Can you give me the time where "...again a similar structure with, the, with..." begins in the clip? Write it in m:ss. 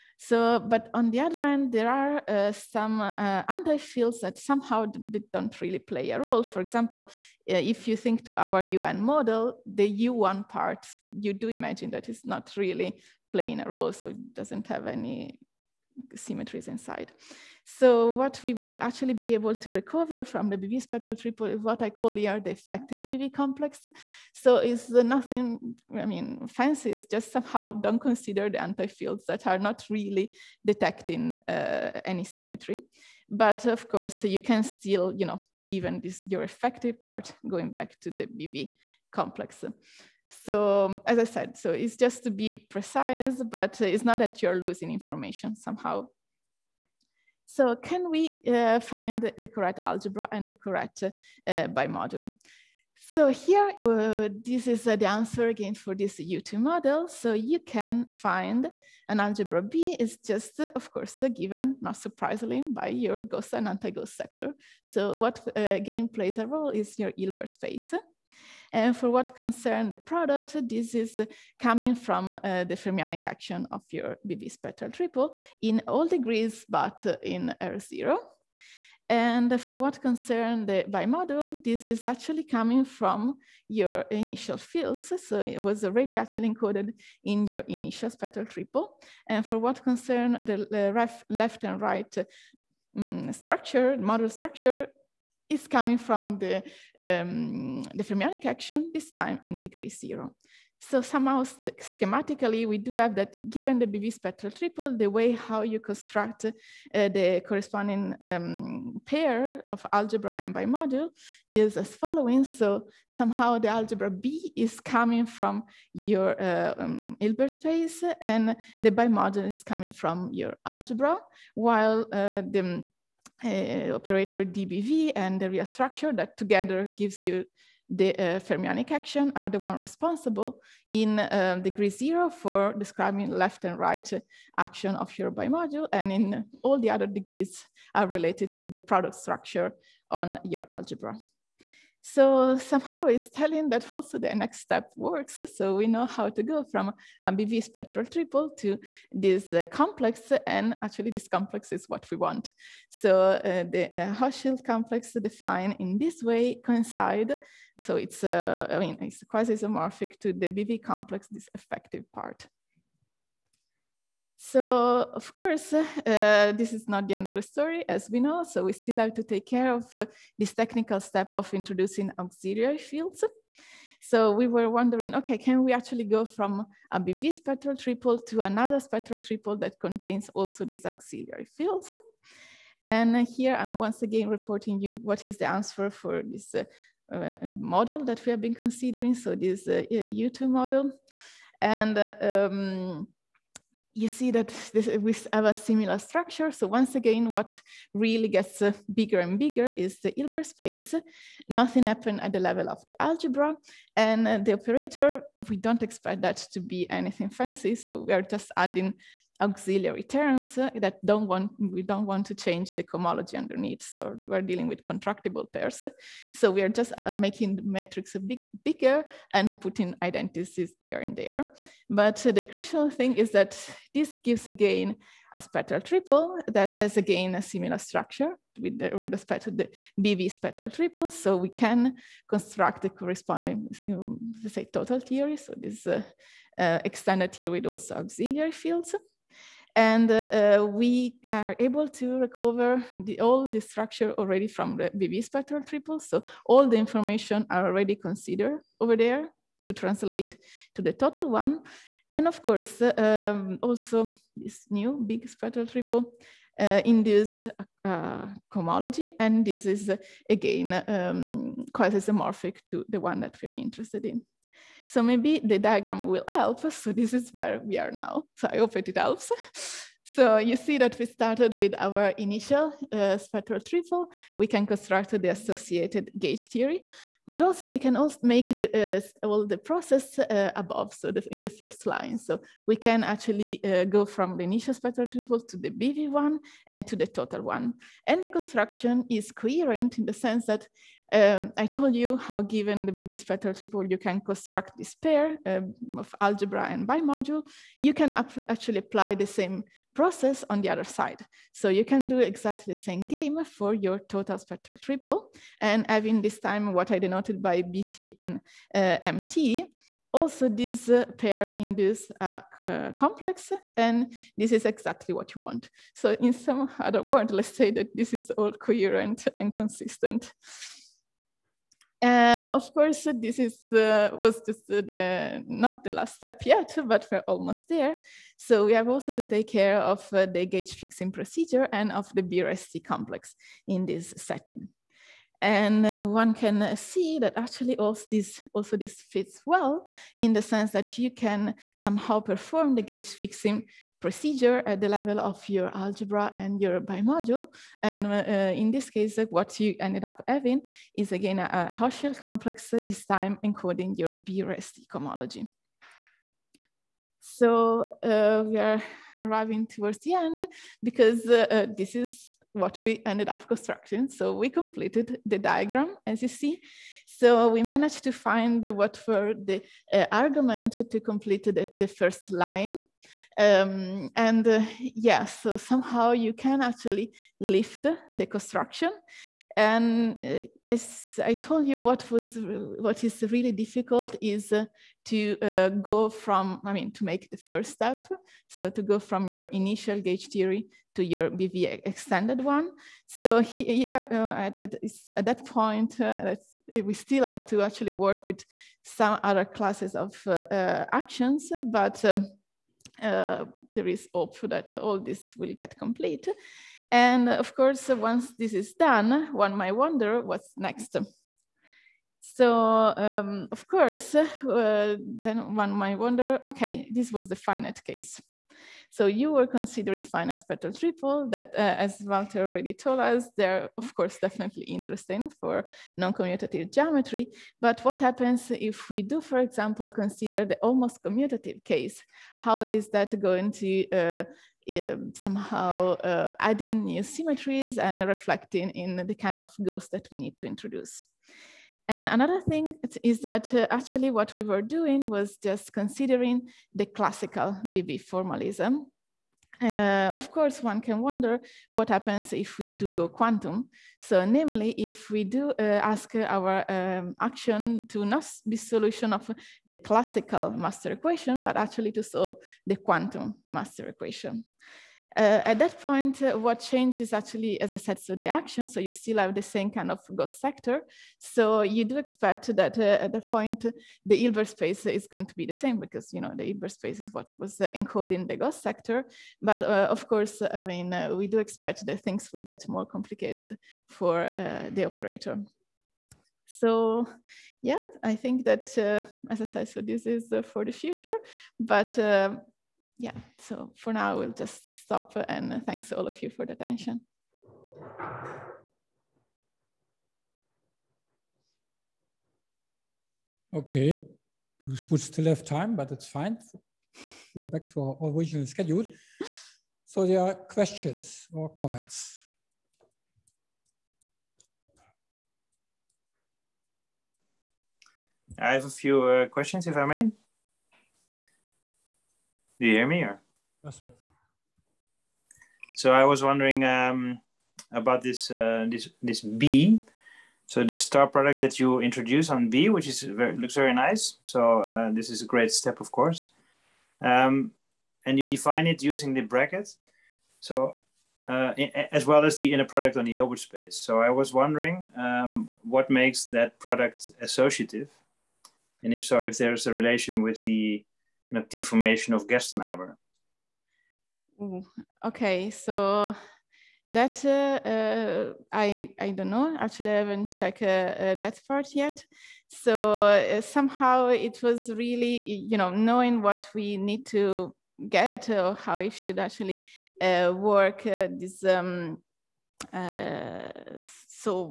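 3:46.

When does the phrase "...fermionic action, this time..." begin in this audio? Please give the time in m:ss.
1:38.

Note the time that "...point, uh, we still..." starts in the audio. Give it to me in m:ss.
6:35.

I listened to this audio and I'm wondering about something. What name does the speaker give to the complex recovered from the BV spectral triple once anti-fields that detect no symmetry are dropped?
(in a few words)
effective BV complex.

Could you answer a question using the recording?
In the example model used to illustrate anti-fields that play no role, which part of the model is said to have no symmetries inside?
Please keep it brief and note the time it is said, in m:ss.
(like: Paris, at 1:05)
U1 part, at 0:10.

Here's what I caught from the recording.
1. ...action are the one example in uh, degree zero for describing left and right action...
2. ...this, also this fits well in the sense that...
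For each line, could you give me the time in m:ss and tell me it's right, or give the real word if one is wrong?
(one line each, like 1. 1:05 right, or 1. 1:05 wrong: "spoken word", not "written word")
1. 2:08 wrong: "responsible", not "example"
2. 5:38 right.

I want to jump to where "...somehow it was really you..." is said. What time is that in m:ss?
9:23.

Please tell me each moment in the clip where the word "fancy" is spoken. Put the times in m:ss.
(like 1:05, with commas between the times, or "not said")
0:26, 3:27.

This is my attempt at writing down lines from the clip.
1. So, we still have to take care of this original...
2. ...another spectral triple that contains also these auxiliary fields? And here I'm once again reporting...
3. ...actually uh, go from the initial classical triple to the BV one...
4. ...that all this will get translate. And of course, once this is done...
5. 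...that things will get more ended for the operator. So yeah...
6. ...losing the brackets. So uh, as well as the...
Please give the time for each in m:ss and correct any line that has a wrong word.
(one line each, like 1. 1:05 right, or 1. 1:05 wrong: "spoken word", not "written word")
1. 2:48 wrong: "technical", not "original"
2. 2:58 right
3. 4:43 wrong: "spectral", not "classical"
4. 6:44 wrong: "complete", not "translate"
5. 8:01 wrong: "complicated", not "ended"
6. 8:58 wrong: "using", not "losing".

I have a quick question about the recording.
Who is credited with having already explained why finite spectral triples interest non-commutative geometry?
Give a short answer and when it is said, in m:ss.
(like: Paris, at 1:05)
Walter, at 7:02.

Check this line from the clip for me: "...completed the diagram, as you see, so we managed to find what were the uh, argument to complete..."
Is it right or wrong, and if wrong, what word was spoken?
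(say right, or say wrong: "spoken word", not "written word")
right.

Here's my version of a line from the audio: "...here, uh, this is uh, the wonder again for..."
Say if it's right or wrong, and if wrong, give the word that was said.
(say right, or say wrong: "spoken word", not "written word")
wrong: "answer", not "wonder".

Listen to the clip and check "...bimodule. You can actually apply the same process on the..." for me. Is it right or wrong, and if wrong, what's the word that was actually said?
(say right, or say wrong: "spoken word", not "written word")
right.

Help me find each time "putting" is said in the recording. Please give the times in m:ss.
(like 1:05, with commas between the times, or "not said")
3:39.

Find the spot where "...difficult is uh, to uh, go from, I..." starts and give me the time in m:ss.
6:23.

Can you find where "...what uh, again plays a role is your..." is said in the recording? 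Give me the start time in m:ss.
1:05.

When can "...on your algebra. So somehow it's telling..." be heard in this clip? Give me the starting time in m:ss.
2:20.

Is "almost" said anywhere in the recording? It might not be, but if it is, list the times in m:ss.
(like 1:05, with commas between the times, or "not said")
5:27, 7:10.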